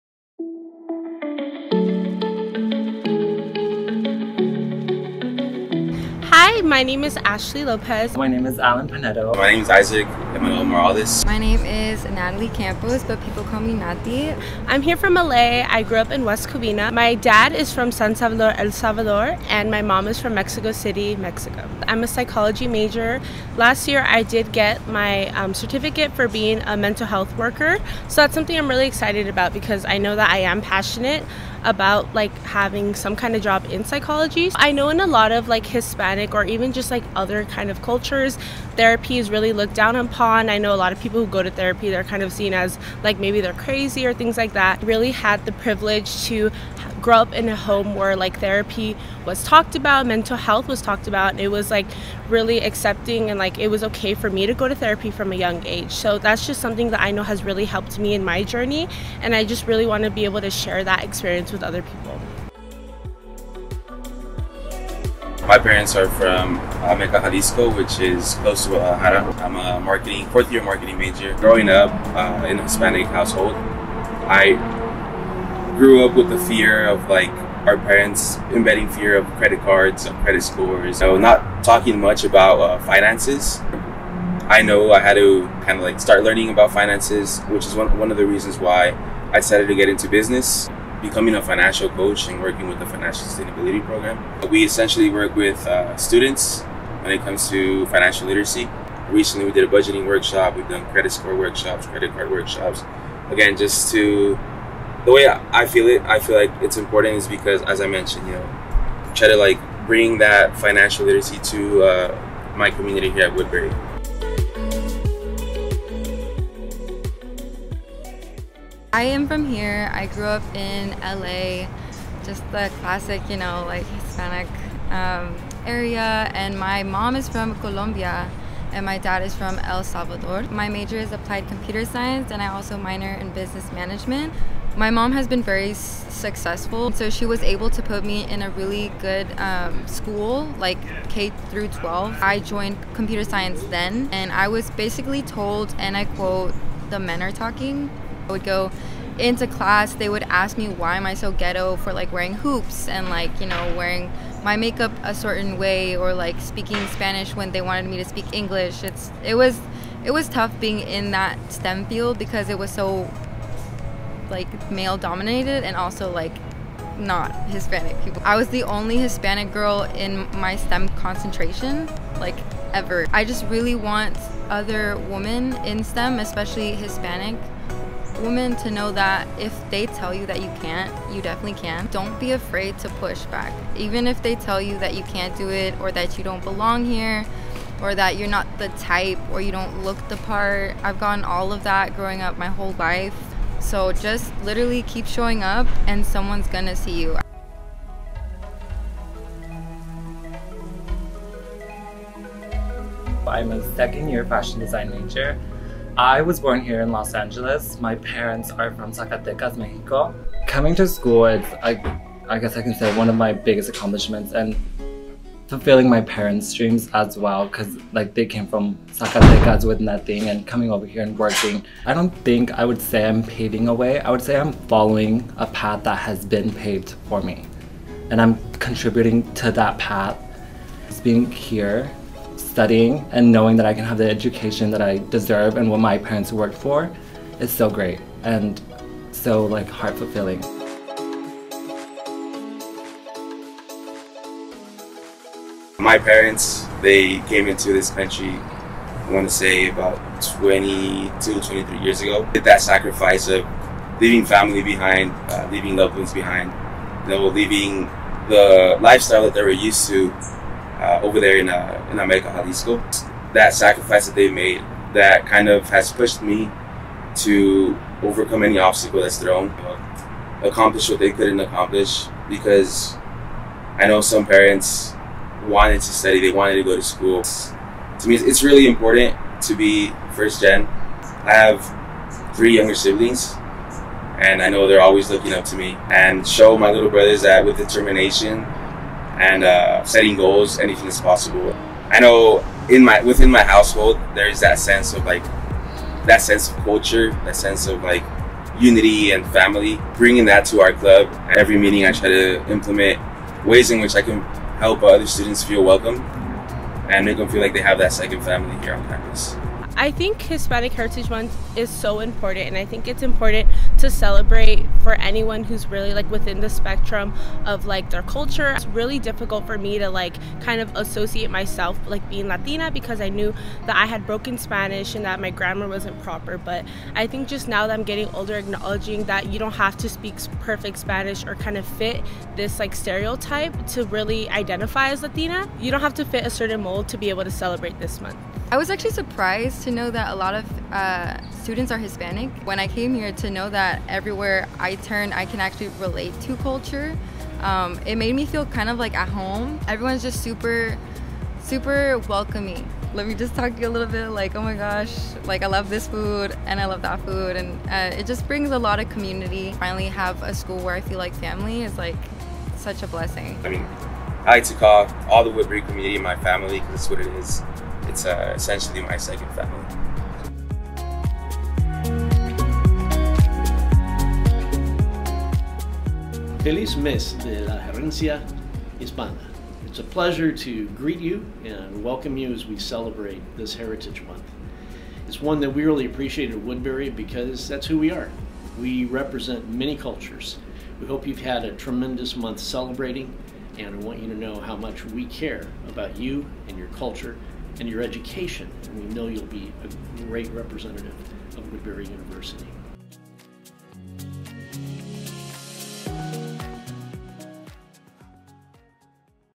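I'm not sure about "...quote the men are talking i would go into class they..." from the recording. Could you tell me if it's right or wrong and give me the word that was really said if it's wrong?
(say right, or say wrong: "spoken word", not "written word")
right.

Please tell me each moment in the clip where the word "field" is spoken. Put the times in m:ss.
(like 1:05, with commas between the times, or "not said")
2:41.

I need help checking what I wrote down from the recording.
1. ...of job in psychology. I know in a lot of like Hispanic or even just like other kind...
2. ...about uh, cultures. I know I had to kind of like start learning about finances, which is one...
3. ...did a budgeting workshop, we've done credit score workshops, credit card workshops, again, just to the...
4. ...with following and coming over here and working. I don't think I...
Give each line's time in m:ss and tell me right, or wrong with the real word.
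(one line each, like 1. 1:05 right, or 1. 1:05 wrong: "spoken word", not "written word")
1. 0:33 right
2. 1:22 wrong: "finances", not "cultures"
3. 1:39 right
4. 3:39 wrong: "nothing", not "following".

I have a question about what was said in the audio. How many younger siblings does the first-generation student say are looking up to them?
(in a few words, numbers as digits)
3.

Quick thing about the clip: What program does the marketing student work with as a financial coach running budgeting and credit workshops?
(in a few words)
financial sustainability program.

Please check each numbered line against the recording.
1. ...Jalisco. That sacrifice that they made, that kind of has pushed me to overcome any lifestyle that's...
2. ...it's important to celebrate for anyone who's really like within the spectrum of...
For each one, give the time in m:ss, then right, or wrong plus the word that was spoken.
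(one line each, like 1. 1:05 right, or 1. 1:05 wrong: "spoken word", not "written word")
1. 4:22 wrong: "obstacle", not "lifestyle"
2. 5:12 right.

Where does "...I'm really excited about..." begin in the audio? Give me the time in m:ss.
0:28.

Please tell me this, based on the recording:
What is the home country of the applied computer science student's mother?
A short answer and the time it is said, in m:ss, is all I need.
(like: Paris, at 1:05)
Colombia, at 2:07.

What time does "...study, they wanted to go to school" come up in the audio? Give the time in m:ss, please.
4:35.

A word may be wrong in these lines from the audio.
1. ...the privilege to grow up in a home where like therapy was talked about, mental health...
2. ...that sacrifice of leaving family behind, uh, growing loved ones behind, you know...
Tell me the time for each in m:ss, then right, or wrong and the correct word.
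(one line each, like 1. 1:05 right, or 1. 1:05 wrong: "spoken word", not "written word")
1. 0:45 right
2. 4:12 wrong: "leaving", not "growing".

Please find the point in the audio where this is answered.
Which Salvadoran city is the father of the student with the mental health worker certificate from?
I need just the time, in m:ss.
0:17.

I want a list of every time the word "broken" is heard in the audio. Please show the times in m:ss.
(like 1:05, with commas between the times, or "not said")
5:24.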